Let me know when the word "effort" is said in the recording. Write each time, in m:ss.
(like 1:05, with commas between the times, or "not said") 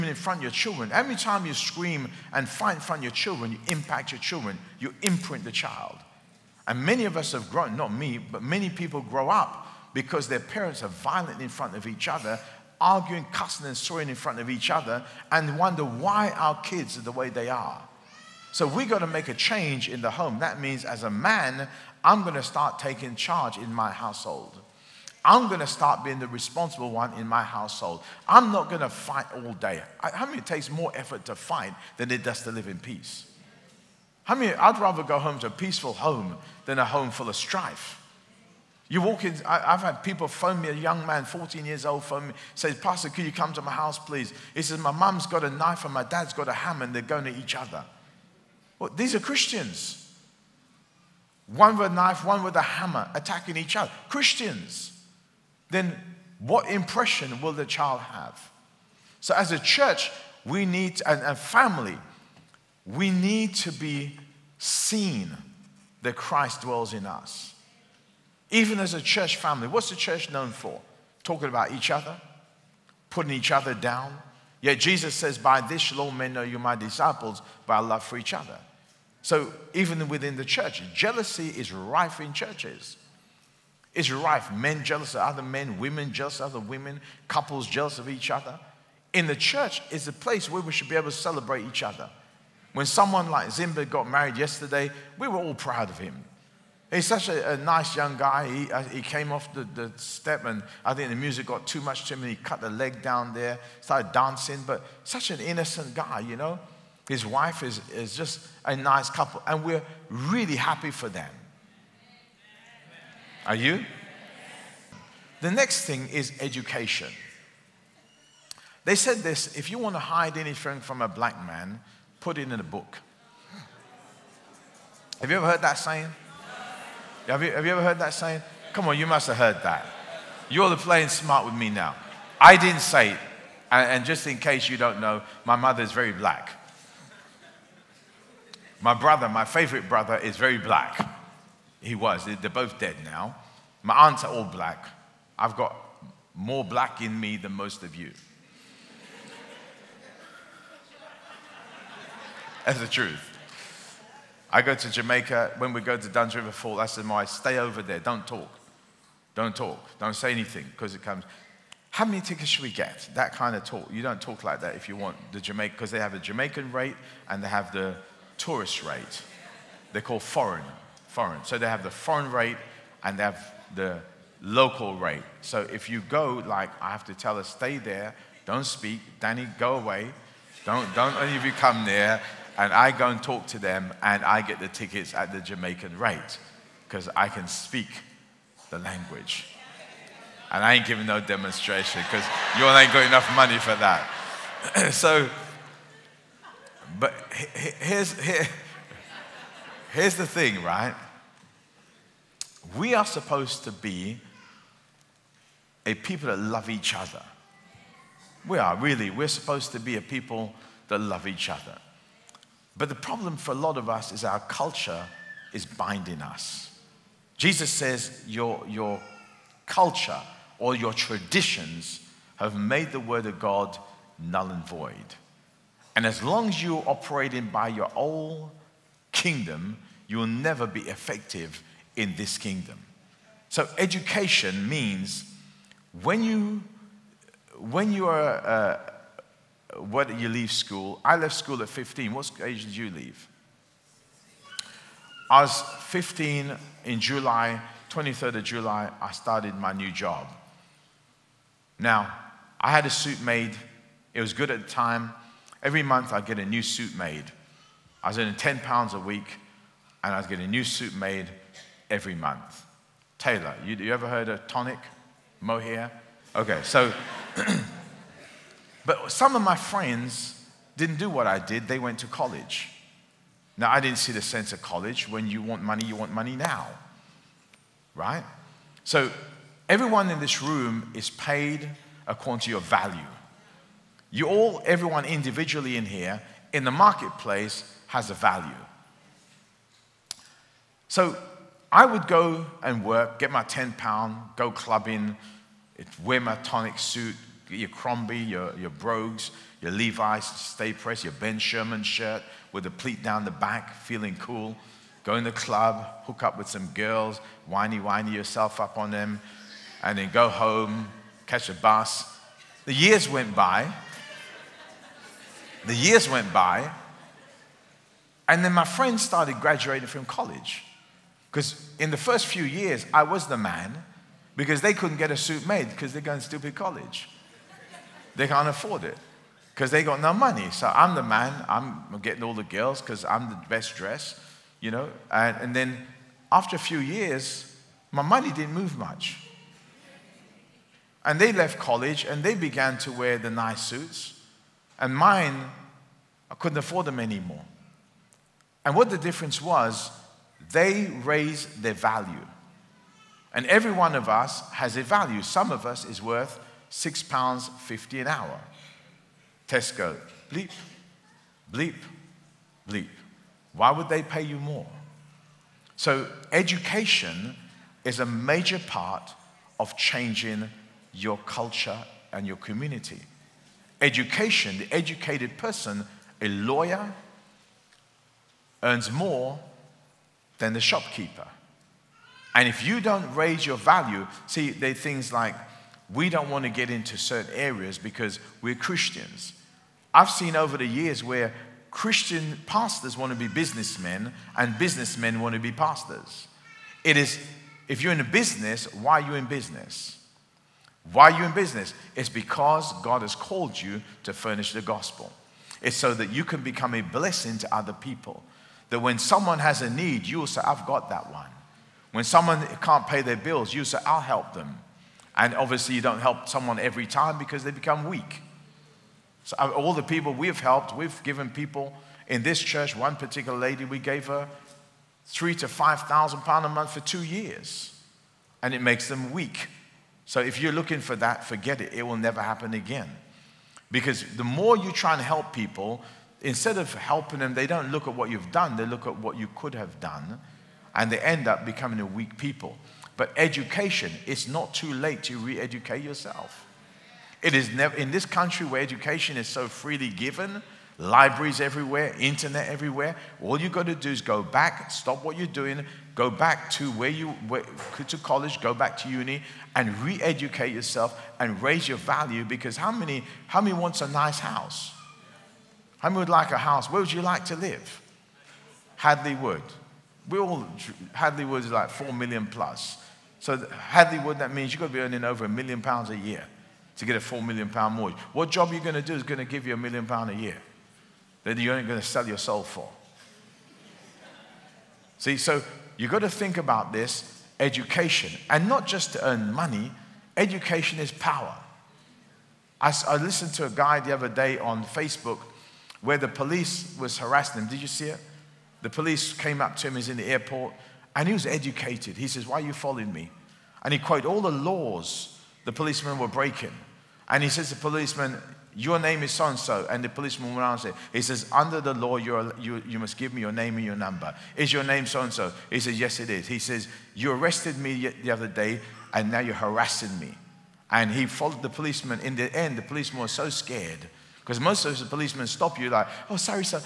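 0:30.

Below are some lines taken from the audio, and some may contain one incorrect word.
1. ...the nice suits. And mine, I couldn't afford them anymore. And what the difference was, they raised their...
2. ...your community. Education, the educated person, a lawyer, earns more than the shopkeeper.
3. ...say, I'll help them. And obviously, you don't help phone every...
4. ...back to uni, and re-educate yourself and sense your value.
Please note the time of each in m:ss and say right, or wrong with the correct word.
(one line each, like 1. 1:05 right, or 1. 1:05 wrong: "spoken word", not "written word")
1. 5:43 right
2. 6:12 right
3. 6:53 wrong: "someone", not "phone"
4. 7:38 wrong: "raise", not "sense".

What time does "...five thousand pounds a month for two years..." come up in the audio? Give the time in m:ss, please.
7:05.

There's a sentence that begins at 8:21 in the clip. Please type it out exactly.
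He says, Why are you following me?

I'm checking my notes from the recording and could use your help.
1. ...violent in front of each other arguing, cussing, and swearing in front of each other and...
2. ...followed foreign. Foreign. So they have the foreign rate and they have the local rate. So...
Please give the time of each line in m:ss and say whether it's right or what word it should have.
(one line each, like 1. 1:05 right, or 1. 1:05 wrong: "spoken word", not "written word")
1. 0:10 right
2. 2:50 wrong: "called", not "followed".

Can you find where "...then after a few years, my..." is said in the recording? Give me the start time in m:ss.
5:35.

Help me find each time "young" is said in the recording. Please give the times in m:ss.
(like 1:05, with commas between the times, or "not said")
0:40, 1:37.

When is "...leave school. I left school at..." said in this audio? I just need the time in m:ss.
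4:00.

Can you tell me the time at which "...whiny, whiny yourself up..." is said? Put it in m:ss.
5:07.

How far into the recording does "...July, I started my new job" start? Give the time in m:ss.
4:08.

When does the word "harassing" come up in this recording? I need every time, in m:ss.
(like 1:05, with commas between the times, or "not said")
8:16, 8:39.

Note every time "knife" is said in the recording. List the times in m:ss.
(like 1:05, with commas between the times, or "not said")
0:45, 0:51.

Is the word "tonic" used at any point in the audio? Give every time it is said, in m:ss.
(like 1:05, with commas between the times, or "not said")
4:24, 4:56.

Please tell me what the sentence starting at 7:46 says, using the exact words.
Where would you like to live?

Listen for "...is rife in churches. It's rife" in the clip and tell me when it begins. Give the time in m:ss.
1:21.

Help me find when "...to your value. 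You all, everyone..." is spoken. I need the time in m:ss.
4:42.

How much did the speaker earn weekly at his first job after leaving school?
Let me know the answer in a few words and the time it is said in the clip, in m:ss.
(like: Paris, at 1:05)
10 pounds, at 4:18.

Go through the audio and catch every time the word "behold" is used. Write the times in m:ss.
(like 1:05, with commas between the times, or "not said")
not said.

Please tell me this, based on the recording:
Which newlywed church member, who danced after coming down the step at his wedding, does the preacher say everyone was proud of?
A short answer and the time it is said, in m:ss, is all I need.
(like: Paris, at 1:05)
Zimba, at 1:33.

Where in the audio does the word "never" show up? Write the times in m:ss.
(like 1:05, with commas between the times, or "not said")
3:50, 7:11, 7:27.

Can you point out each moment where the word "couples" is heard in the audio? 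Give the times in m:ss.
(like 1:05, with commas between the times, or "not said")
1:27, 1:49.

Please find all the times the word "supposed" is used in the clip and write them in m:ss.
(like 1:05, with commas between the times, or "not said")
3:23, 3:29.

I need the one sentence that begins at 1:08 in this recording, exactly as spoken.
Even as a church family, what's the church known for?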